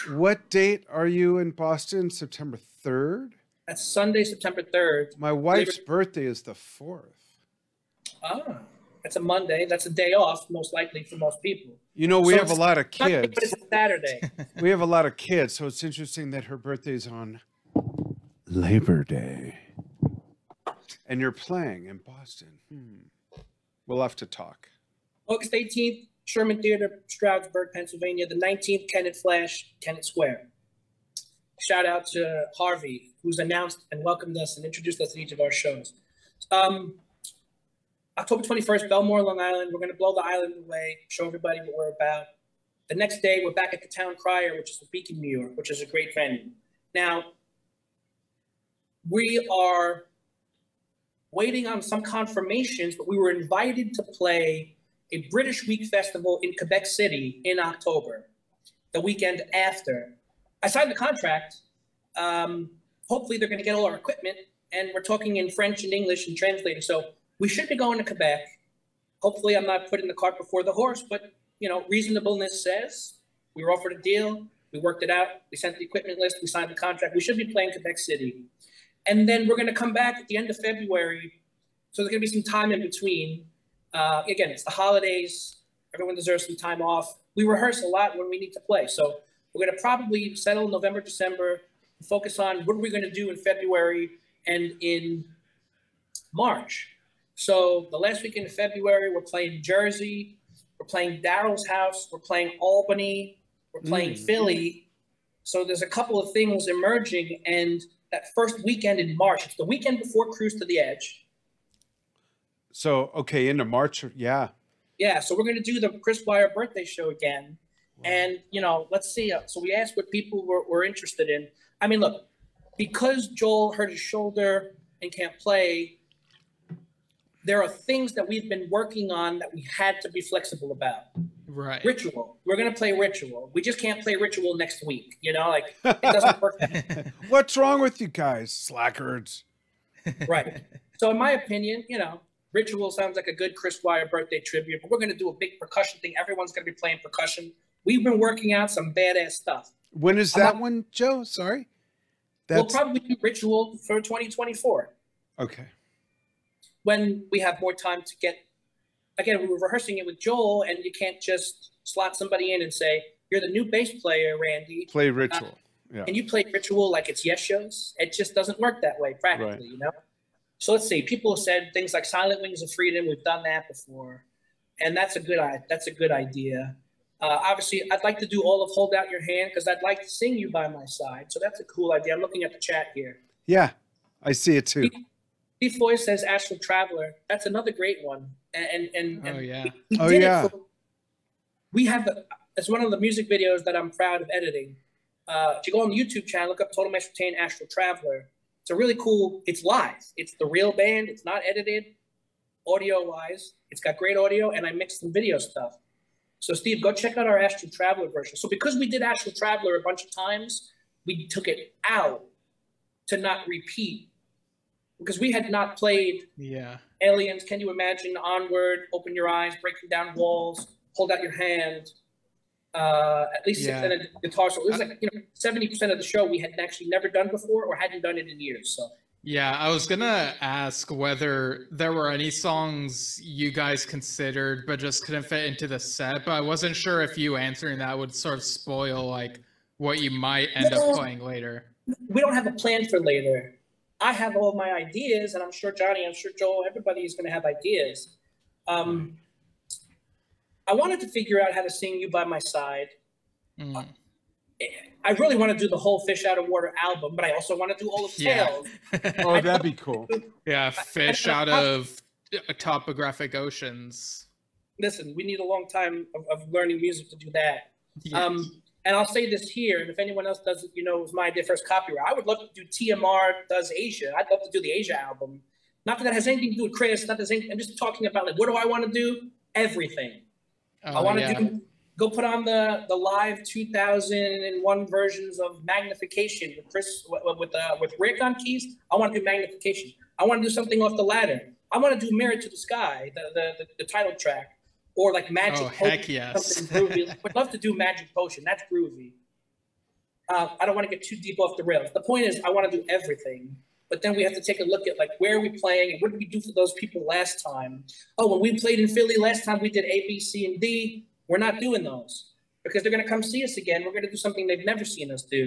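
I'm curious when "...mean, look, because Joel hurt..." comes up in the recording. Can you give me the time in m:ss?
2:01.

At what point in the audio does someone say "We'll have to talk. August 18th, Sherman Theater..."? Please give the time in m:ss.
0:23.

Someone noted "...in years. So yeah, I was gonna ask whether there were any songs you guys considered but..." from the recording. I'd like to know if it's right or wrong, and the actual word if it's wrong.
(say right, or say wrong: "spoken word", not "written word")
right.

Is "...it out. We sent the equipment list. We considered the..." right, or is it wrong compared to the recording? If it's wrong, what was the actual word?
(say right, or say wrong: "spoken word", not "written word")
wrong: "signed", not "considered".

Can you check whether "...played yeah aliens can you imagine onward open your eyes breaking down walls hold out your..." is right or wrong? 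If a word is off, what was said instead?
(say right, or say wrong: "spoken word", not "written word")
right.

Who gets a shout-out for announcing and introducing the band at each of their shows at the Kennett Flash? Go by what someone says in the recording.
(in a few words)
Harvey.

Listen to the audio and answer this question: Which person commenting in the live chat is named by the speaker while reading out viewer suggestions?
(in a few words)
Steve Foy.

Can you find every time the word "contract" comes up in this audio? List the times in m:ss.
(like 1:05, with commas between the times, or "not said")
1:00, 1:16.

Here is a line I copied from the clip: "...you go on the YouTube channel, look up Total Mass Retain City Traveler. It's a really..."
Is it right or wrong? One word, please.
wrong.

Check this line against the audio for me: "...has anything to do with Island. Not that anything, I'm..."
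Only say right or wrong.
wrong.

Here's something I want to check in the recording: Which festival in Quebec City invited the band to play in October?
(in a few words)
British Week Festival.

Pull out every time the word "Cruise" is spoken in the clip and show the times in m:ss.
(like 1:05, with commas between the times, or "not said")
1:50.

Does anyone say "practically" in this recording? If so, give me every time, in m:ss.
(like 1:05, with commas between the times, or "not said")
2:49.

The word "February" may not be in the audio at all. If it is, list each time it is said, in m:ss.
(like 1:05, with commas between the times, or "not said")
1:20, 1:33, 1:38.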